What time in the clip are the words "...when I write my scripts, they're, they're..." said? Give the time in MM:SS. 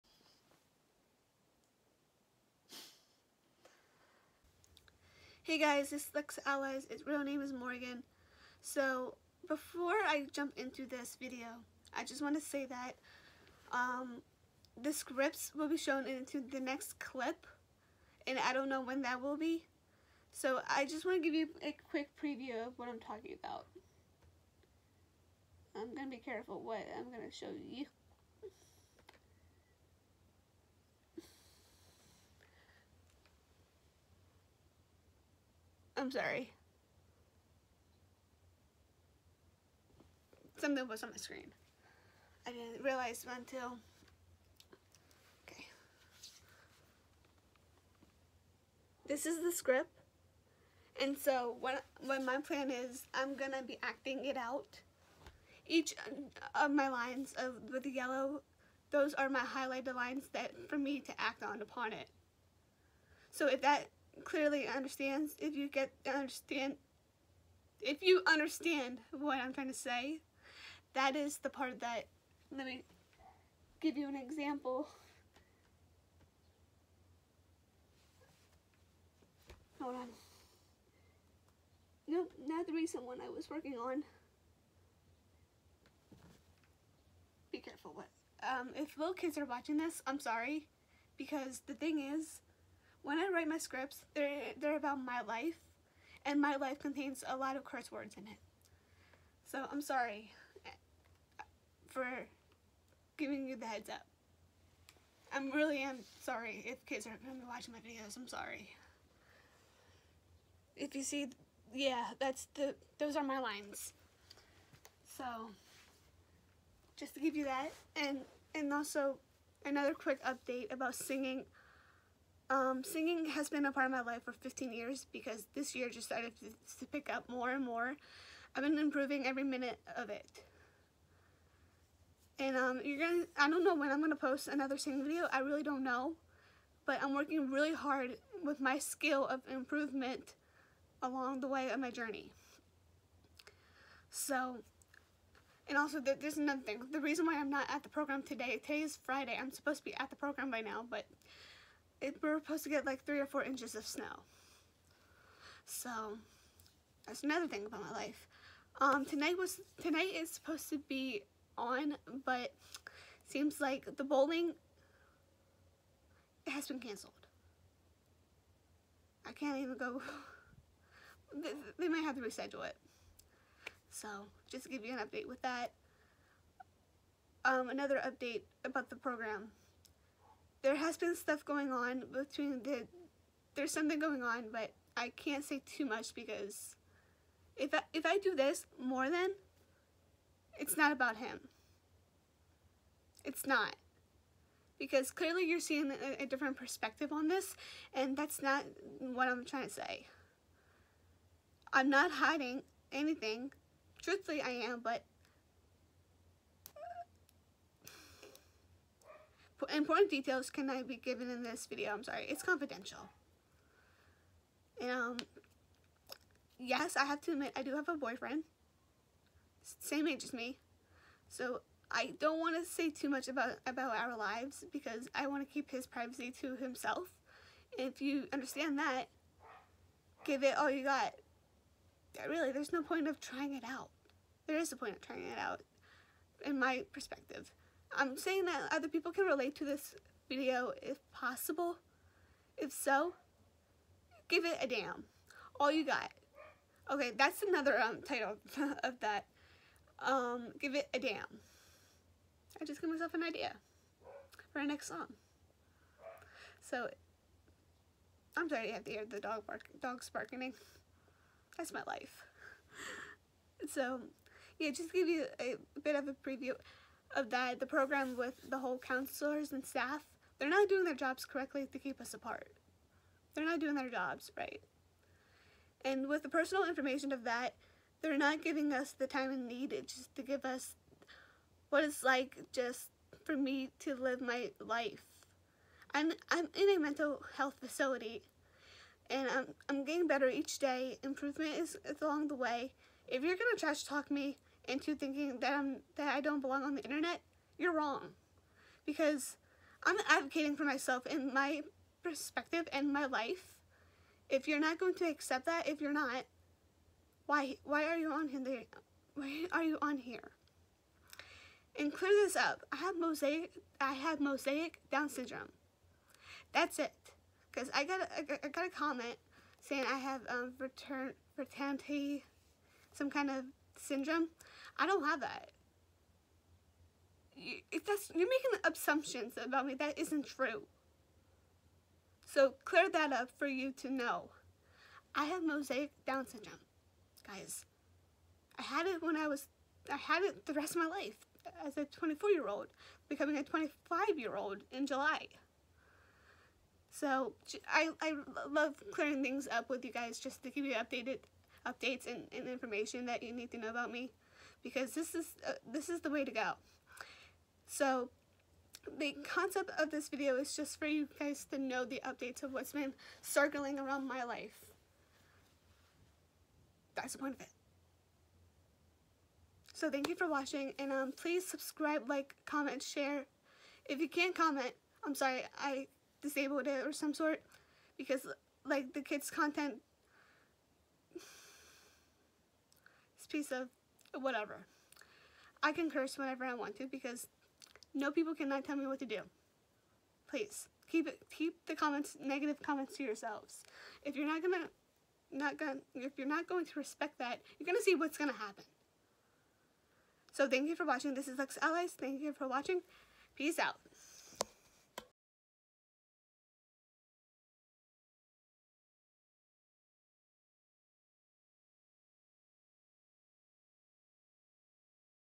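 01:33.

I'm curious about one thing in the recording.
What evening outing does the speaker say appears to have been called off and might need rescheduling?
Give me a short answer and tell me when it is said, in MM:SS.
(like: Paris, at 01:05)
Bowling, at 02:44.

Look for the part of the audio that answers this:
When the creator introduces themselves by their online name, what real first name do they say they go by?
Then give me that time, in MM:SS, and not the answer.
00:07.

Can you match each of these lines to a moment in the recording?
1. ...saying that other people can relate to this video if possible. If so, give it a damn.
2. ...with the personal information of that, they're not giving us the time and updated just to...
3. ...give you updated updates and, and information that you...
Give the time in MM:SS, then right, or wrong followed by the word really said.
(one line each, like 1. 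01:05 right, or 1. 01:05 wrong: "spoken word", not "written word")
1. 03:58 right
2. 04:36 wrong: "needed", not "updated"
3. 05:50 right.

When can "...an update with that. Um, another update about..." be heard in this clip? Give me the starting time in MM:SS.
02:54.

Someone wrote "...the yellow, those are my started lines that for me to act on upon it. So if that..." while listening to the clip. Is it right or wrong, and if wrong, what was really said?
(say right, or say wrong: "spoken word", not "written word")
wrong: "highlighted", not "started".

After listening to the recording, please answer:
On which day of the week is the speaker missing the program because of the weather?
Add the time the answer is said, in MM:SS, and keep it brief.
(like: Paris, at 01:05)
Friday, at 02:29.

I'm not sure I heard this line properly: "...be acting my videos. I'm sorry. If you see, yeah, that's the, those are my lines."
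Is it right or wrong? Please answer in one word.
wrong.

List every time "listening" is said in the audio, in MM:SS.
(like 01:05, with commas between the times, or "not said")
not said.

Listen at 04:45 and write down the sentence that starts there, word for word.
I'm, I'm in a mental health facility and I'm, I'm getting better each day.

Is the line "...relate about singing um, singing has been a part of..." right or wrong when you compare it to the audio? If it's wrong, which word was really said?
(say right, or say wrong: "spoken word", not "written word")
wrong: "update", not "relate".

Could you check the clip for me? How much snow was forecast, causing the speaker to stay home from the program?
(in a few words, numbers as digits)
3 or 4 inches.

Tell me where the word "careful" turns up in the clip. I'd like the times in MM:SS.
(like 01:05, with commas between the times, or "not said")
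00:26, 01:27.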